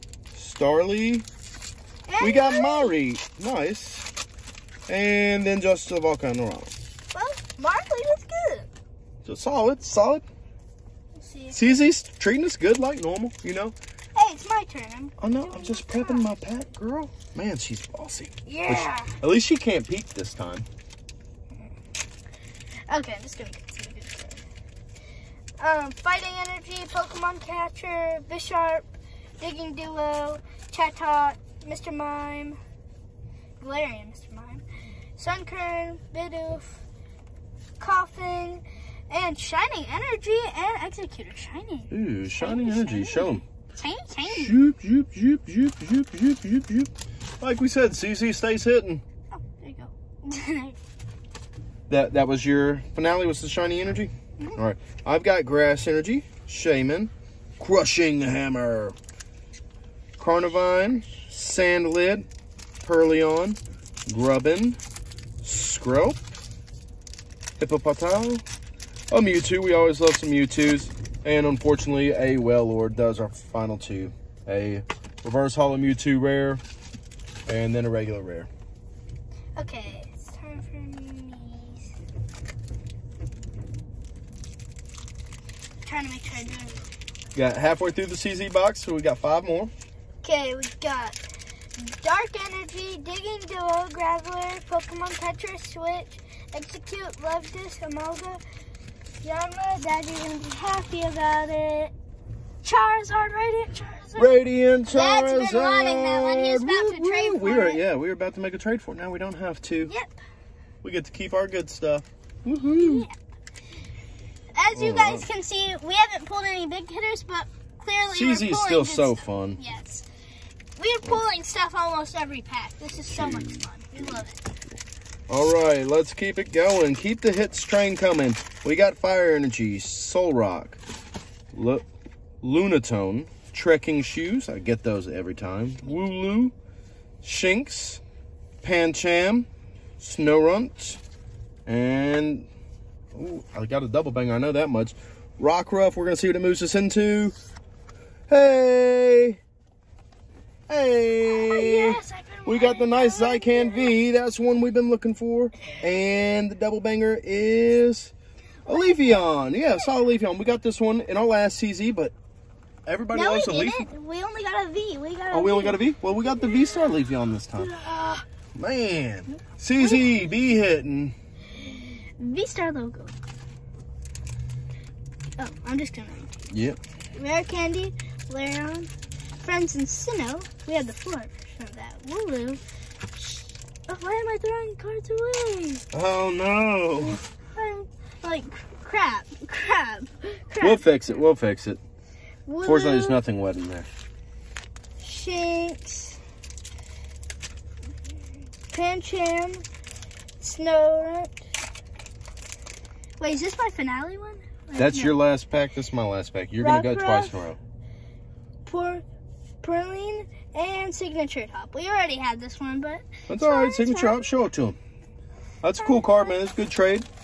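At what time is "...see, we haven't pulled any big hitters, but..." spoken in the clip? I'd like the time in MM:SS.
01:55.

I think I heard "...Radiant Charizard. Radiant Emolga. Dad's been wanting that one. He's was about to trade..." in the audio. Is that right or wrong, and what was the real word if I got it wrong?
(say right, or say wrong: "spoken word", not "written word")
wrong: "Charizard", not "Emolga".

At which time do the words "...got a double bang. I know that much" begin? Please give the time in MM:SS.
02:23.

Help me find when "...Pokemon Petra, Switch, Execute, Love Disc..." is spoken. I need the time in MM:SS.
01:34.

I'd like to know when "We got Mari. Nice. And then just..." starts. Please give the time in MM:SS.
00:02.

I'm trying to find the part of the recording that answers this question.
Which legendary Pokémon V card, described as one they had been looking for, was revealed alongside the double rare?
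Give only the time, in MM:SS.
02:33.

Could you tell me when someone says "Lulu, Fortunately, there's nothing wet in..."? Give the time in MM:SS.
03:12.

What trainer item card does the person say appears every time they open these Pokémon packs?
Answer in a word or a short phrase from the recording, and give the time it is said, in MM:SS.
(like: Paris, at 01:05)
Trekking Shoes, at 02:13.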